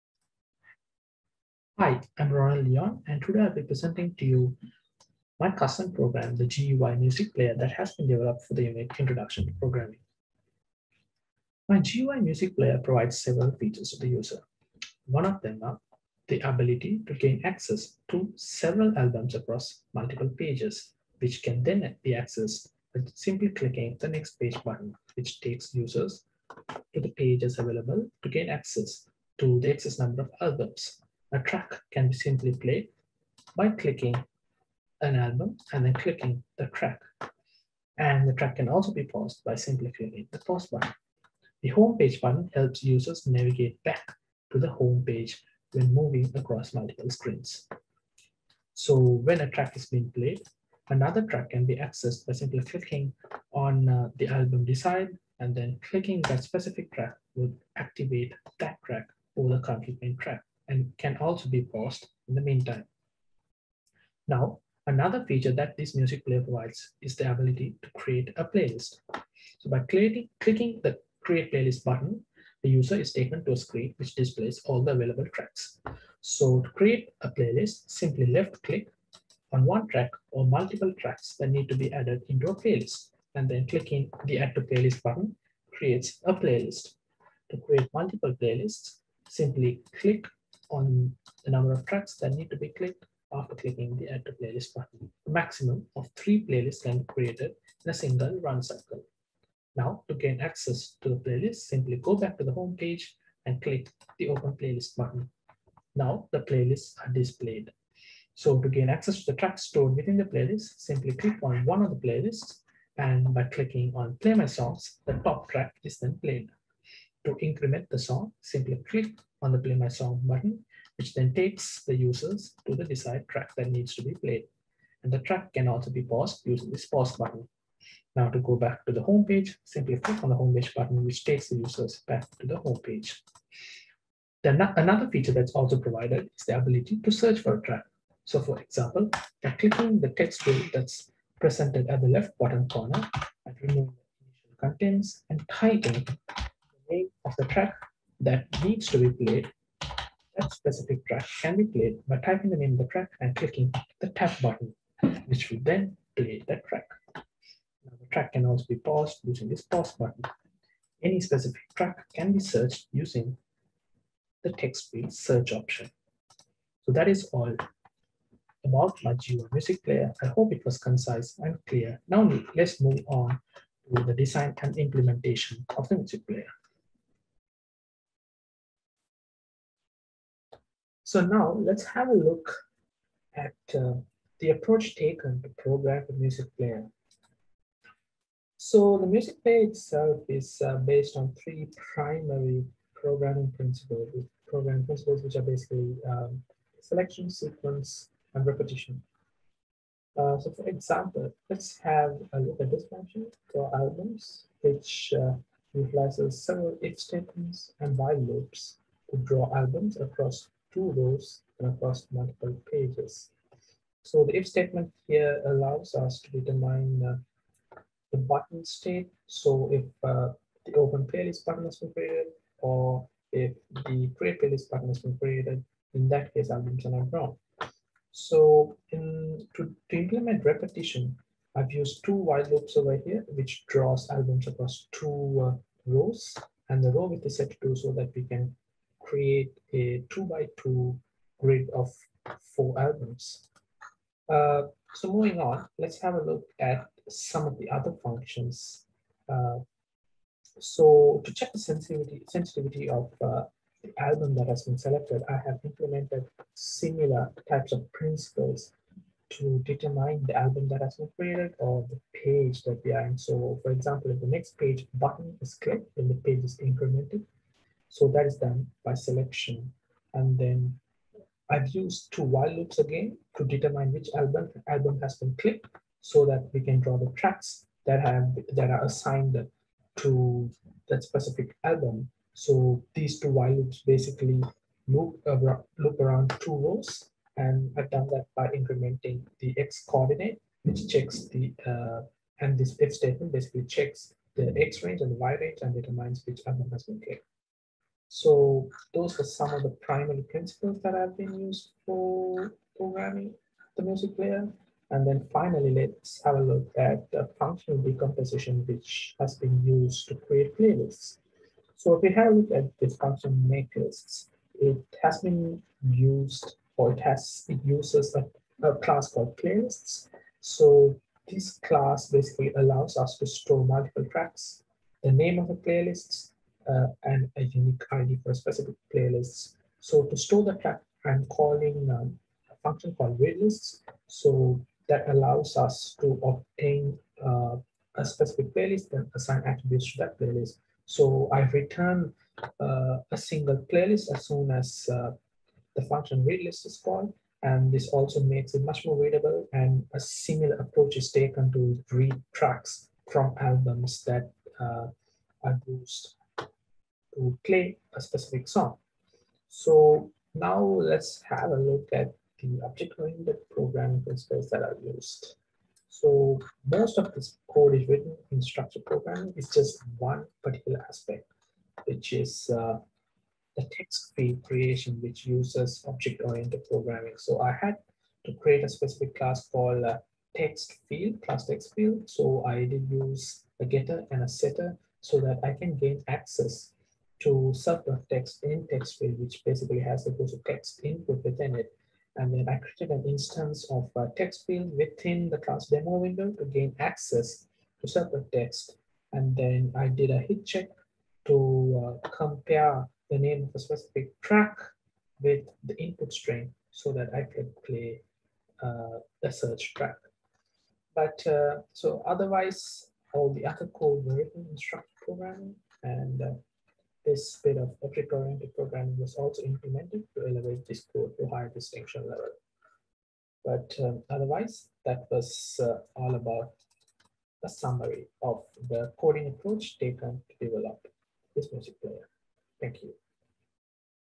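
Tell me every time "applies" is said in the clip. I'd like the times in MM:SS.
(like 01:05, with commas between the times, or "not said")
not said.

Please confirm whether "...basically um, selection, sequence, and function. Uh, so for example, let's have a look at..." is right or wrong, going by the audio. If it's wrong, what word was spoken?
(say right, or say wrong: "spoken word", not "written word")
wrong: "repetition", not "function".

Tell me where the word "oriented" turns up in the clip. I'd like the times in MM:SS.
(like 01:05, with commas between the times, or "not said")
06:02, 06:15, 06:57.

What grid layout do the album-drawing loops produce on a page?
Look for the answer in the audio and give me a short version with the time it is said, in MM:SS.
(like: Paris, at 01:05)
two by two, at 04:00.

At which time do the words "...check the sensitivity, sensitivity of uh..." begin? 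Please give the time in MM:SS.
04:11.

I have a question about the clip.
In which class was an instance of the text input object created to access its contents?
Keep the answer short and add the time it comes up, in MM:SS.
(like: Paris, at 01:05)
demo window, at 06:35.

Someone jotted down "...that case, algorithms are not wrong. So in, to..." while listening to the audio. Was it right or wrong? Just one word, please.
right.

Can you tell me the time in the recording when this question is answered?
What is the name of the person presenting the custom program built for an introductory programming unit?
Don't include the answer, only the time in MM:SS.
00:02.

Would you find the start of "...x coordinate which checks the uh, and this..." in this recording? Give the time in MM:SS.
04:49.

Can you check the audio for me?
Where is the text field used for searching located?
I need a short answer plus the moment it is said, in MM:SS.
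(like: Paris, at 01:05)
left bottom corner, at 02:22.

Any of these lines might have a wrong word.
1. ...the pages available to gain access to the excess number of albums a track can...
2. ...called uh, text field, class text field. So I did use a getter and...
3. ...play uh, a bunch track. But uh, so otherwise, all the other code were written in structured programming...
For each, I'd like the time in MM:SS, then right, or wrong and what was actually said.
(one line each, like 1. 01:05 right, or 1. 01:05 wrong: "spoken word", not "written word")
1. 00:27 right
2. 06:19 right
3. 06:47 wrong: "search", not "bunch".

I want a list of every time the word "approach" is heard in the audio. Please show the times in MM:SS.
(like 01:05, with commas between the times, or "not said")
03:04, 05:50, 07:09.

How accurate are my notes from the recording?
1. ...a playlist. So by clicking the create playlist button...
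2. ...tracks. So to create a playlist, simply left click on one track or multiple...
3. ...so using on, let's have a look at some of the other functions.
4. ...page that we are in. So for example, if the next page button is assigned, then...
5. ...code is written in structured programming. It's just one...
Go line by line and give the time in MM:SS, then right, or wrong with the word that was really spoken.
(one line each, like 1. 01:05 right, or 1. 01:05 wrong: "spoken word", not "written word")
1. 01:08 right
2. 01:15 right
3. 04:04 wrong: "moving", not "using"
4. 04:22 wrong: "clicked", not "assigned"
5. 06:07 right.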